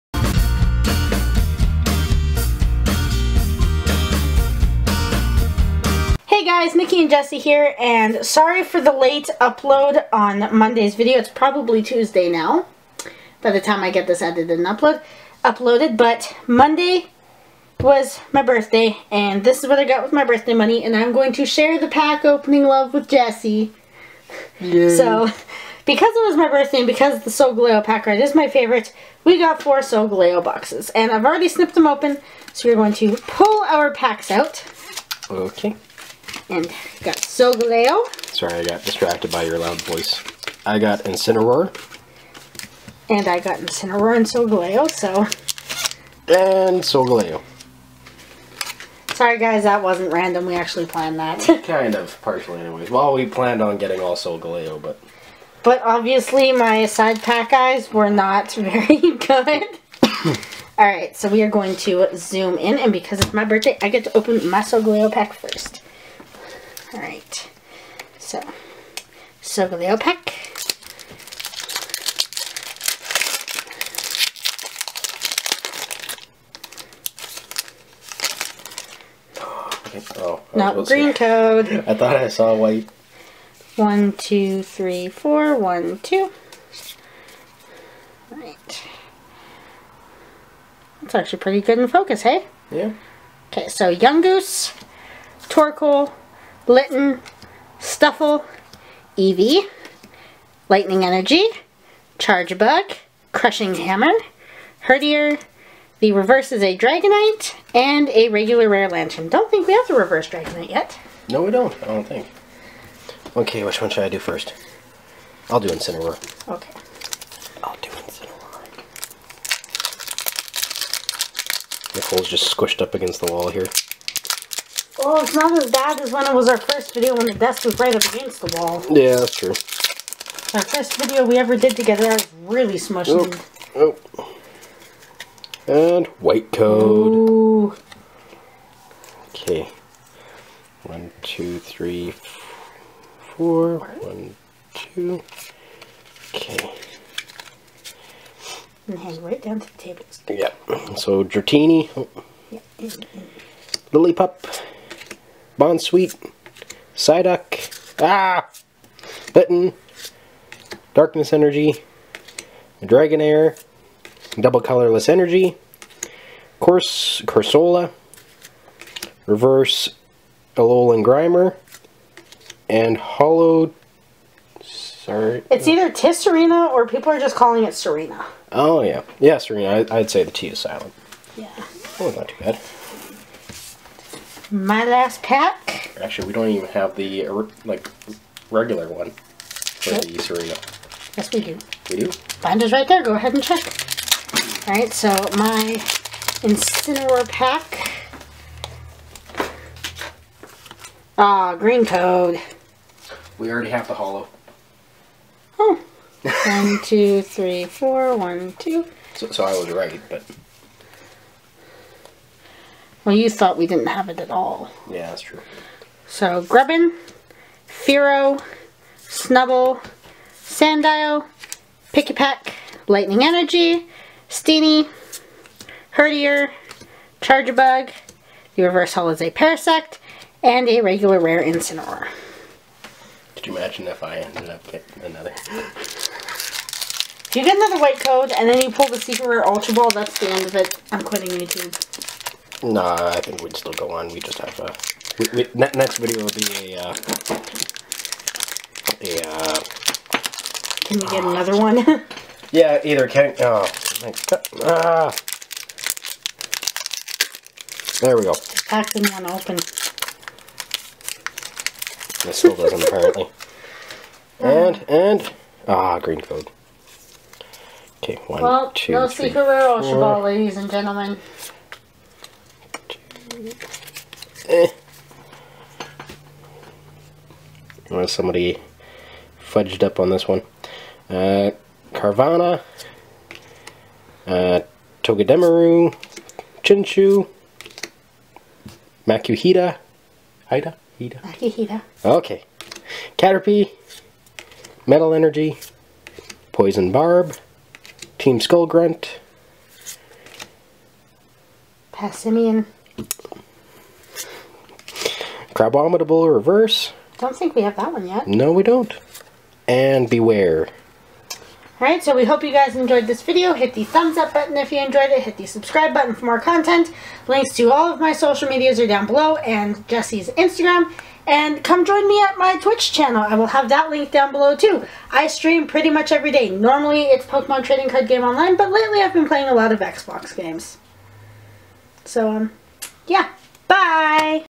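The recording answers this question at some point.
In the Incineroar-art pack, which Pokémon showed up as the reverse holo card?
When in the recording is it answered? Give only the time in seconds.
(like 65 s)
229 s.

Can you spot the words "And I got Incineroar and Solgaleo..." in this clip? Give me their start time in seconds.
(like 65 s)
43 s.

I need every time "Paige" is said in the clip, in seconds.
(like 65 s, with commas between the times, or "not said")
not said.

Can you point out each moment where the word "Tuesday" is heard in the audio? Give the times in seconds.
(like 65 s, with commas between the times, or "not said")
11 s.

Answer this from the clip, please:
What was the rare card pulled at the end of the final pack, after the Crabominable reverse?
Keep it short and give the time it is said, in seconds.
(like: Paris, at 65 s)
Bewear, at 310 s.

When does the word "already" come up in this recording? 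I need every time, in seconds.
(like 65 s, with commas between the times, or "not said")
31 s, 203 s.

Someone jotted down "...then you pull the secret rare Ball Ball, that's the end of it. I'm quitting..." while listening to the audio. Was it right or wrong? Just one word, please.
wrong.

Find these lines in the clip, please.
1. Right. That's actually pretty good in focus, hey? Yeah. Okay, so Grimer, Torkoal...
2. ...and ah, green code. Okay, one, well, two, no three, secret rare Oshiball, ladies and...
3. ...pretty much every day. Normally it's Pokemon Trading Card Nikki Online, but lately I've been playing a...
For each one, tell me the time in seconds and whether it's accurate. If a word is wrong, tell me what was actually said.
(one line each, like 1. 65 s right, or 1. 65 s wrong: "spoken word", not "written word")
1. 88 s wrong: "Yungoos", not "Grimer"
2. 264 s right
3. 325 s wrong: "Game", not "Nikki".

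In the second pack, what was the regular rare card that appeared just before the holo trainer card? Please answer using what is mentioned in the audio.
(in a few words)
Corsola.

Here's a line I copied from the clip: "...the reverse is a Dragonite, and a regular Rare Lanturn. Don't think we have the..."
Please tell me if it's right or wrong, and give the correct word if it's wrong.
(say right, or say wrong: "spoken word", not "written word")
right.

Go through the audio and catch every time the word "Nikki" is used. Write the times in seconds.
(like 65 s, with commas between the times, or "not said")
6 s.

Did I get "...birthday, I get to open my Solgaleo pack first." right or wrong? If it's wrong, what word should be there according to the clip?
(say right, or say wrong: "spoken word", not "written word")
right.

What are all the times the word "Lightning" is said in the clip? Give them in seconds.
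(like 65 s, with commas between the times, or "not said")
100 s, 222 s.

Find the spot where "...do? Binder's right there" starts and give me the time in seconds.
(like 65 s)
192 s.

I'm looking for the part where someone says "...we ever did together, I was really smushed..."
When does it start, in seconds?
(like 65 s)
131 s.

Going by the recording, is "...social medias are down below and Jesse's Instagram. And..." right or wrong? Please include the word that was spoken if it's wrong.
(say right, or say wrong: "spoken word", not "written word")
right.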